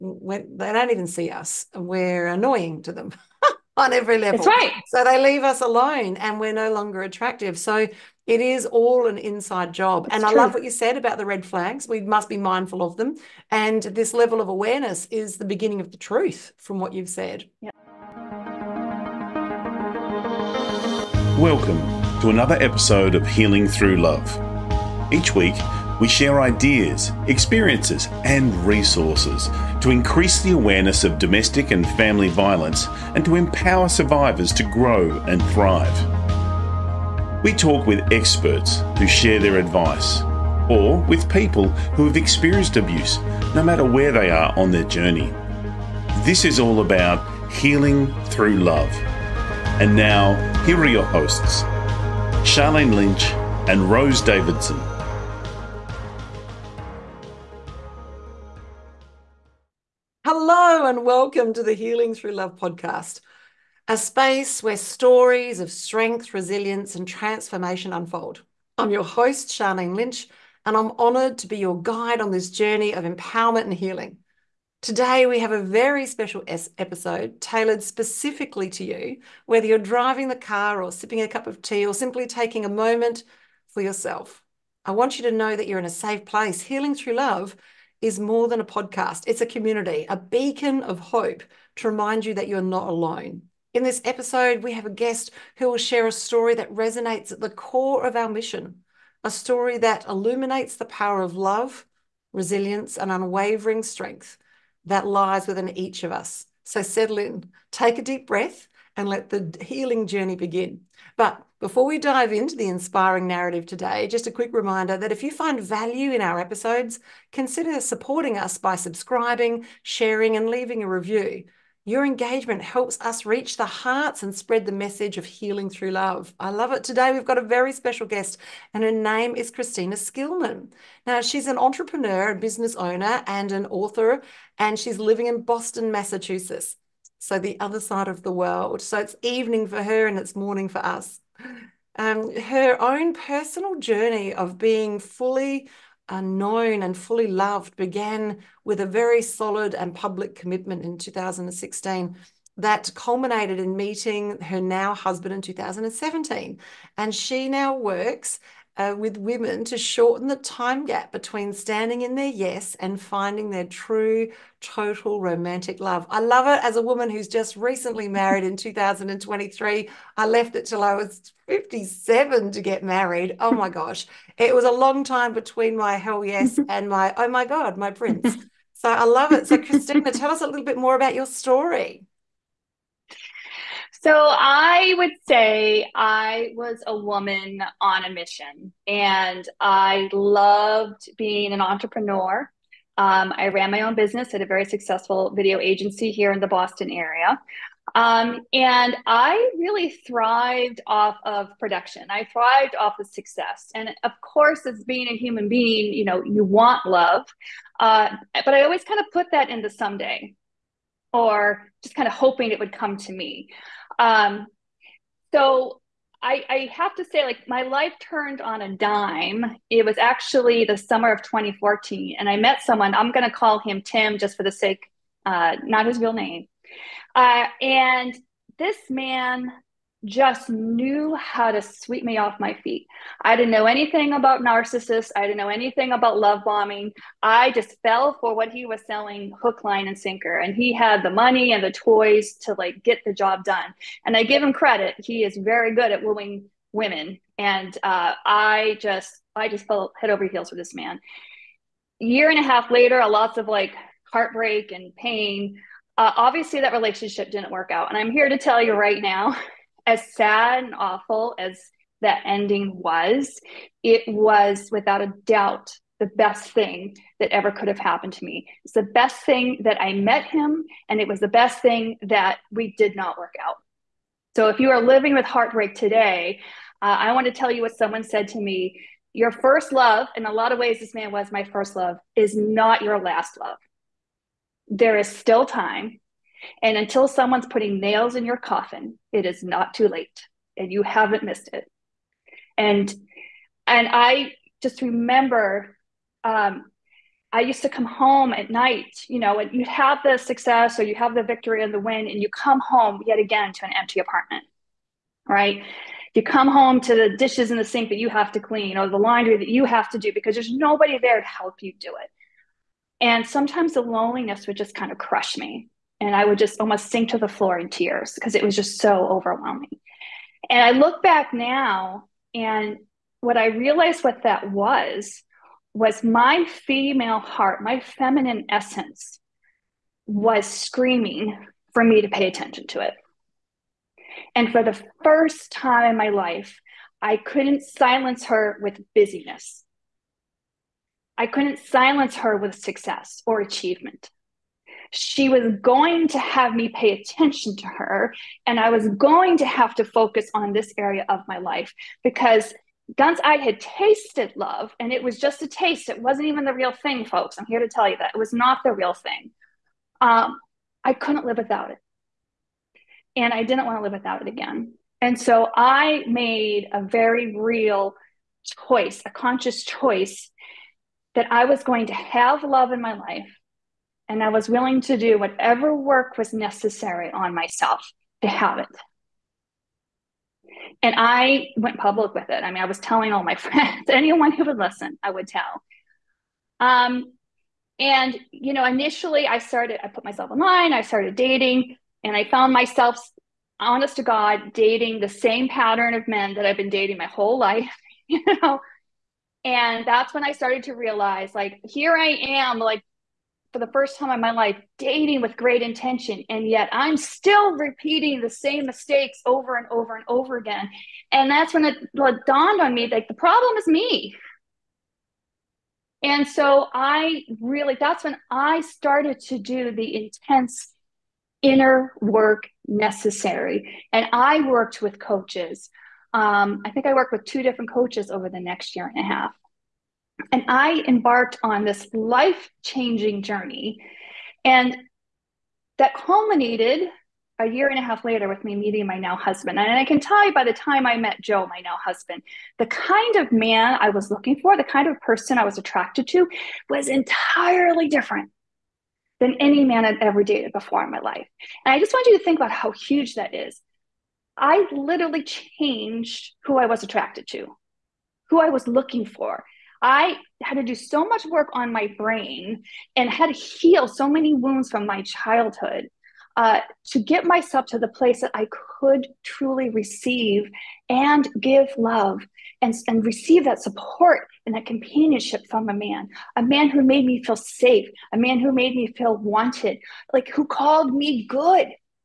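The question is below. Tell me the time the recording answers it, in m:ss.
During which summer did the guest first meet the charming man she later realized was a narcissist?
3:40.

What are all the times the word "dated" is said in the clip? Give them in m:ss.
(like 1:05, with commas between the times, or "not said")
7:30.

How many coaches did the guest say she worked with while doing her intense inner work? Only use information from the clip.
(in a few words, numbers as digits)
2.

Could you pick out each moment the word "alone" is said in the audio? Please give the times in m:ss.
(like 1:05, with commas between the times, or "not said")
0:05, 1:32.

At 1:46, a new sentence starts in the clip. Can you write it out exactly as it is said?
So settle in, take a deep breath, and let the healing journey begin.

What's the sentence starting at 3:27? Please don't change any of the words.
Uh, but I always kind of put that into someday or just kind of hoping it would come to me.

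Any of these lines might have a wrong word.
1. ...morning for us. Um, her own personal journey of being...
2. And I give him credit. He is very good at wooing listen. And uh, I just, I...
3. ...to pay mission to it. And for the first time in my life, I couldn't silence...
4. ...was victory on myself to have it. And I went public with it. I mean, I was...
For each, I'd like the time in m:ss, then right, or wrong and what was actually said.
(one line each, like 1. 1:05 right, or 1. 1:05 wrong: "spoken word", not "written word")
1. 2:20 right
2. 4:04 wrong: "women", not "listen"
3. 5:32 wrong: "attention", not "mission"
4. 6:16 wrong: "necessary", not "victory".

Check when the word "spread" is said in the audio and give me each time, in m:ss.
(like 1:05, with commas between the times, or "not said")
2:04.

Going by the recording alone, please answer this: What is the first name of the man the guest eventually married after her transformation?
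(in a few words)
Joe.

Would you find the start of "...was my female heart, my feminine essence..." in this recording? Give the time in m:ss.
5:25.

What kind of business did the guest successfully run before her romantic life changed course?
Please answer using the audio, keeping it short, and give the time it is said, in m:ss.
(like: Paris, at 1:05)
video agency, at 3:15.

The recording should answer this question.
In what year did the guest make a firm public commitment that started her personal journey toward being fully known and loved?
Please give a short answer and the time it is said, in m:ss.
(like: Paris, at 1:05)
2016, at 2:30.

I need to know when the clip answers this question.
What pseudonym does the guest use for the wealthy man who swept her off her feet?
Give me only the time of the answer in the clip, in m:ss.
3:43.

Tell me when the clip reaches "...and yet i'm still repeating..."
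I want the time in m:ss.
6:46.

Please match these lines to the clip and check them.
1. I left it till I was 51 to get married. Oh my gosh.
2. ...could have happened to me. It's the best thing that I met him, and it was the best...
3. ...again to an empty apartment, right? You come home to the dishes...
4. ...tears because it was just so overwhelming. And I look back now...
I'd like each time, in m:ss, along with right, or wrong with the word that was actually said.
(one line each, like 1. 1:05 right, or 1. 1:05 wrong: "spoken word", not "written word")
1. 2:50 wrong: "57", not "51"
2. 4:27 right
3. 5:03 right
4. 5:17 right.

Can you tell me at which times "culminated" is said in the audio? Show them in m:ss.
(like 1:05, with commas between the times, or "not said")
2:32, 7:15.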